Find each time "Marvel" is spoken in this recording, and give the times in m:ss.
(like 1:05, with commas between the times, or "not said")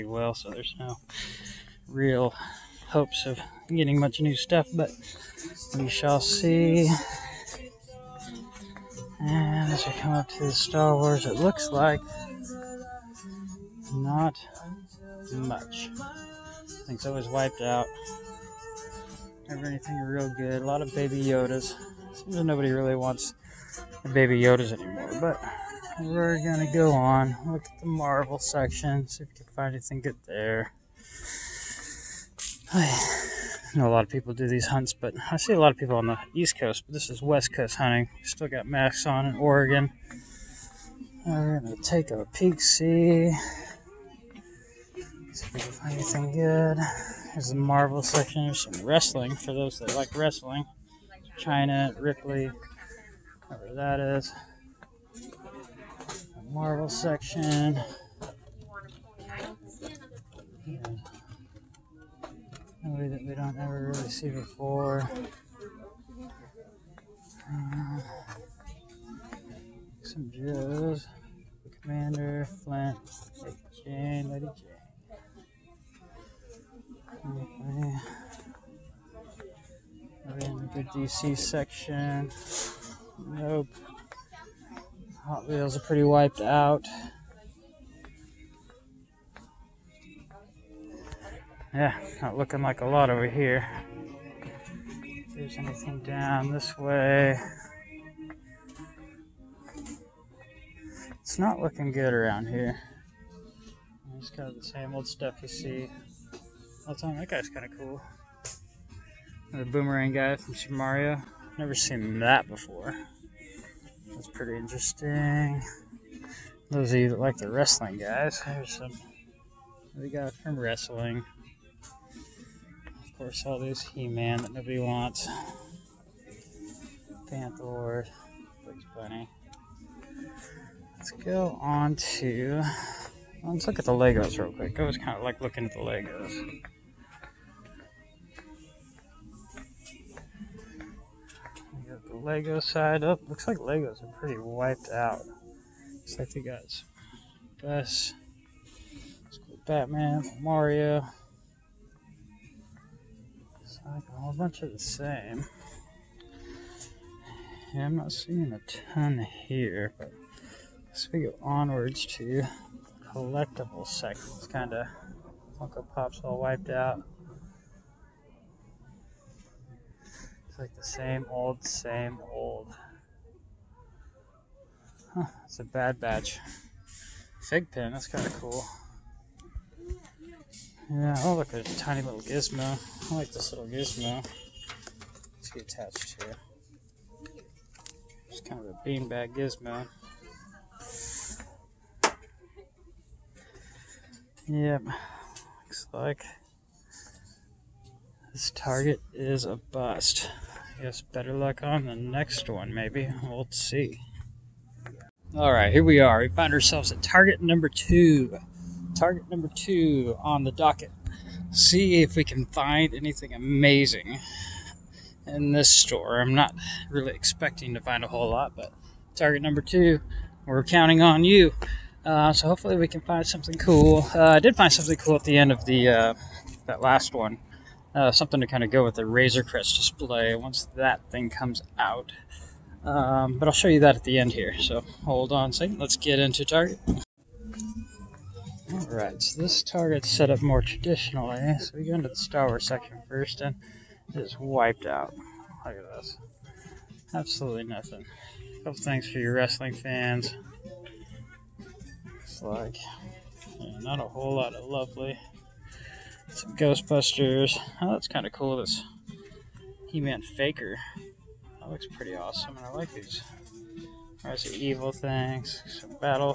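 0:27, 0:47, 0:56.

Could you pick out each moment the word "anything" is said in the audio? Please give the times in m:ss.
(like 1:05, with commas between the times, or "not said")
0:19, 0:29, 0:45, 1:35, 3:32.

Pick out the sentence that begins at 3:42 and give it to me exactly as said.
Uh, so hopefully we can find something cool.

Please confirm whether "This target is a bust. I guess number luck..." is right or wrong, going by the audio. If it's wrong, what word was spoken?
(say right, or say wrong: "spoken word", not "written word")
wrong: "better", not "number".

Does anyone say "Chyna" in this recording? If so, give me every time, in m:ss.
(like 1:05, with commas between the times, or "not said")
0:51.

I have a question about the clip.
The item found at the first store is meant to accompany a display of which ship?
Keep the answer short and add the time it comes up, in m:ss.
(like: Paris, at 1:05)
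Razor Crest, at 3:49.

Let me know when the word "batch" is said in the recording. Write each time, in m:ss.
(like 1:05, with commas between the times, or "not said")
2:55.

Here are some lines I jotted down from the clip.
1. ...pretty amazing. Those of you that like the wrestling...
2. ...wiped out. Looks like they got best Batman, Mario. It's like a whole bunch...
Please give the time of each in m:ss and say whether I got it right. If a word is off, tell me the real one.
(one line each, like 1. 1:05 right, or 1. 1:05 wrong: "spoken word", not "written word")
1. 1:54 wrong: "interesting", not "amazing"
2. 2:24 right.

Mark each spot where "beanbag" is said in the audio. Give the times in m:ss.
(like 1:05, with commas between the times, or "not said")
3:08.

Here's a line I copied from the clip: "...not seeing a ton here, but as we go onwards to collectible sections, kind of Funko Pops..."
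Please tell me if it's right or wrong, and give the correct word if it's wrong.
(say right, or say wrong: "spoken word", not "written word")
right.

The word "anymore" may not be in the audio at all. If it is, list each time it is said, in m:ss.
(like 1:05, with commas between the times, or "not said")
0:24.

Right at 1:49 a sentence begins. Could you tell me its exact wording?
The boomerang guy from Super Mario.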